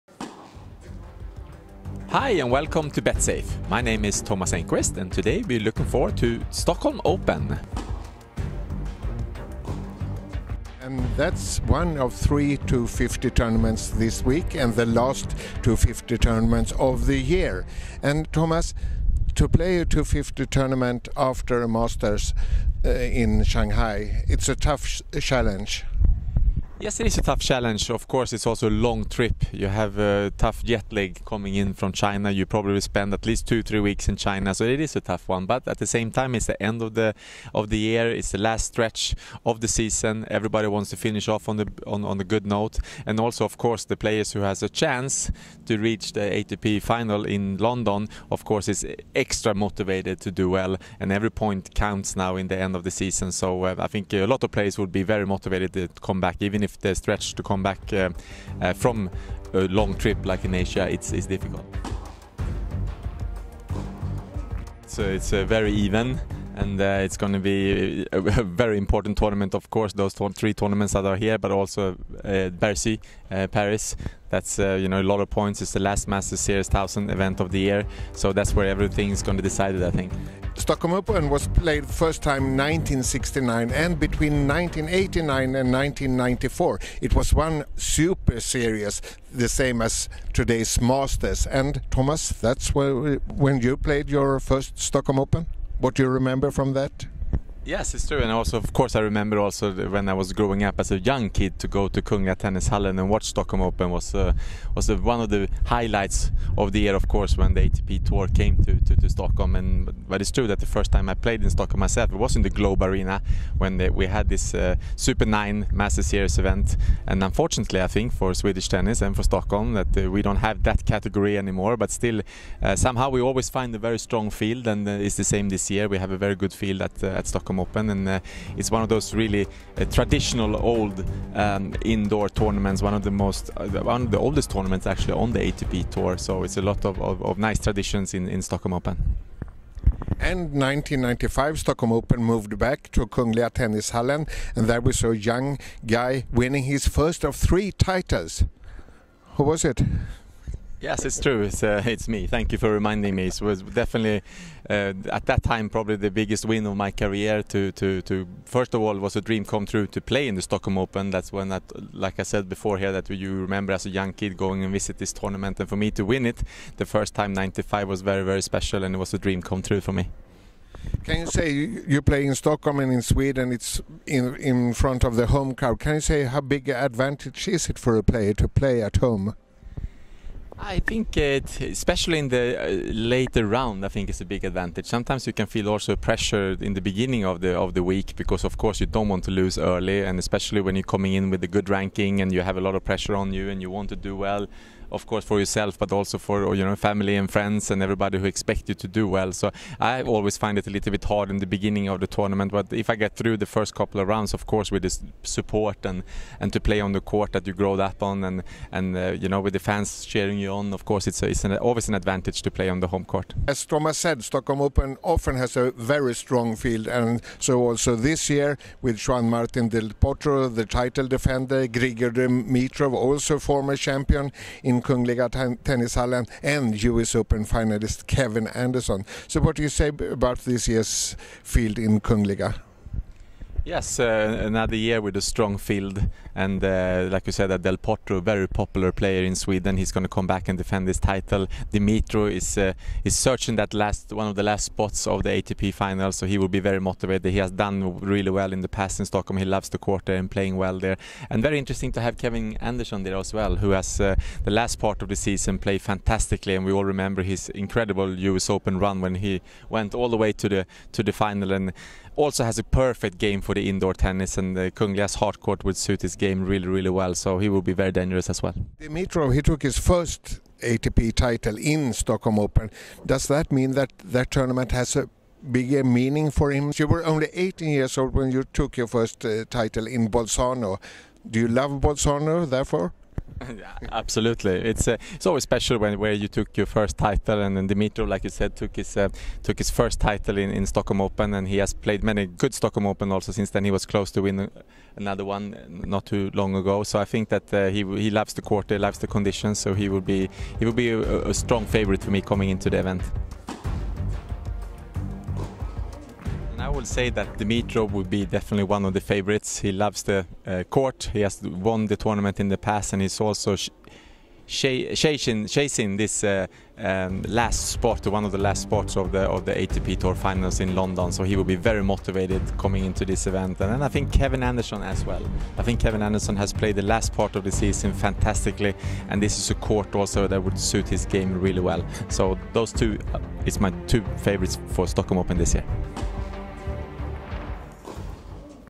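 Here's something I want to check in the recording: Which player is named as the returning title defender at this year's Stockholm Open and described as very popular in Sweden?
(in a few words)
Juan Martin Del Potro.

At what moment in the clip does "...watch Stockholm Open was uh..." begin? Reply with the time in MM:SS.
01:43.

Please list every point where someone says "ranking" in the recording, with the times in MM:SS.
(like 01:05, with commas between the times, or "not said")
03:11.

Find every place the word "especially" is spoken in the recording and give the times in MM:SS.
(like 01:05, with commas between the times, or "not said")
03:01, 03:10.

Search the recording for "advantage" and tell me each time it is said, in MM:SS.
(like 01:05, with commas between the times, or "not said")
02:56, 03:04, 03:31.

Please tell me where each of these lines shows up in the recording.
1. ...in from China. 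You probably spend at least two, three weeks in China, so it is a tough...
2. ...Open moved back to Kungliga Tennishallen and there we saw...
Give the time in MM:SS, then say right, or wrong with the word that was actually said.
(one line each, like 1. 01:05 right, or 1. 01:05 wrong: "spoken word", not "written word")
1. 00:31 right
2. 02:21 right.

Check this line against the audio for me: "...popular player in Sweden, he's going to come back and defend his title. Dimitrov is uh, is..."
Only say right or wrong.
right.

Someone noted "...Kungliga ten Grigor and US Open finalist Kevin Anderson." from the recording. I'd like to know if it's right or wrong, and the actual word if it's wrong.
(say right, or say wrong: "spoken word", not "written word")
wrong: "Tennishallen", not "Grigor".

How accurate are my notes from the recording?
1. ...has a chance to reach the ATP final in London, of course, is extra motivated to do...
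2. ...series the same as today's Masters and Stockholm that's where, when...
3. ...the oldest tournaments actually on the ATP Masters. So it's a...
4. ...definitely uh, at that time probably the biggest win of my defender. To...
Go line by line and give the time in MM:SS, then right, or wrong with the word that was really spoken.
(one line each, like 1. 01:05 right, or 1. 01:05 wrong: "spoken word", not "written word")
1. 00:44 right
2. 01:28 wrong: "Thomas", not "Stockholm"
3. 02:14 wrong: "Tour", not "Masters"
4. 02:33 wrong: "career", not "defender".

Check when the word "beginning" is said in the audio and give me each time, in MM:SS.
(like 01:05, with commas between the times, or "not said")
03:06, 03:21.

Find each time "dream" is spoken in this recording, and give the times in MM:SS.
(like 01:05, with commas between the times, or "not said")
02:39, 02:49.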